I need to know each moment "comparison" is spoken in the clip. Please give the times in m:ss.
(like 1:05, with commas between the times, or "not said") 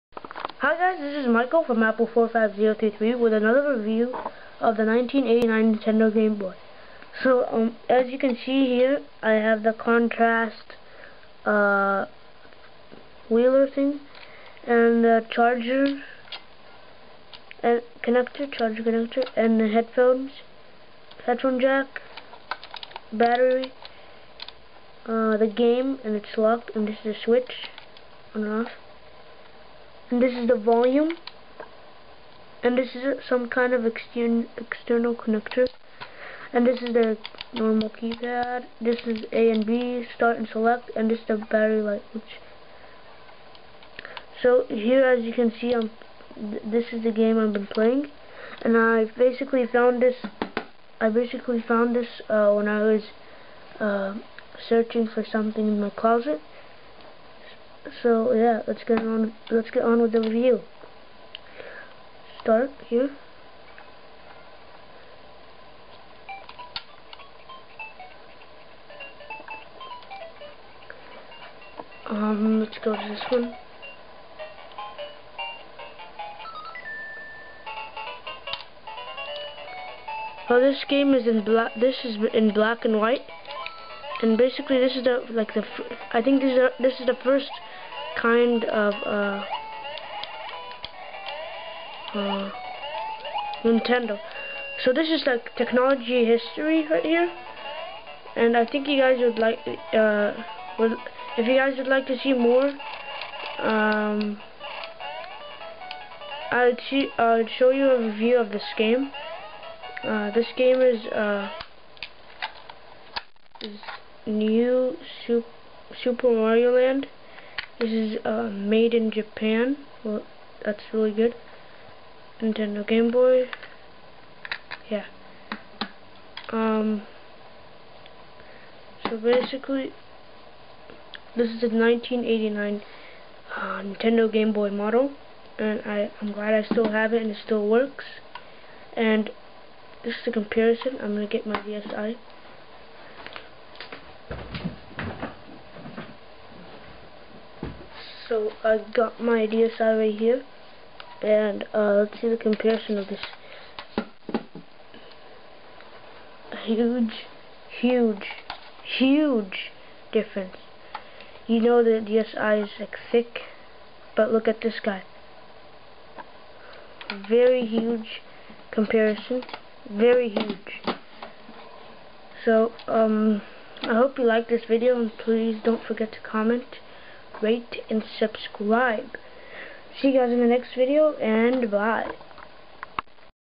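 2:20, 2:32, 2:48.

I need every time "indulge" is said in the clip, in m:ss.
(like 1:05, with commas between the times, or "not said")
not said.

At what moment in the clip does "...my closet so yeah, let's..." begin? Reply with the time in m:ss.
0:55.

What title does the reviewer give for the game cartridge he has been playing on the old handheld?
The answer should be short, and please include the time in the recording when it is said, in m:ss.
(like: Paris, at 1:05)
New Super Mario Land, at 1:54.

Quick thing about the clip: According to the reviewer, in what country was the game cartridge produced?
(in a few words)
Japan.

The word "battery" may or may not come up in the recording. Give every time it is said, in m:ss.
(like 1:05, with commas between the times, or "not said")
0:23, 0:41.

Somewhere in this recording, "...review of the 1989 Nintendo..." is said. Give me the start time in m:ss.
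0:03.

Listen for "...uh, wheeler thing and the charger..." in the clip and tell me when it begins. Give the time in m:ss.
0:11.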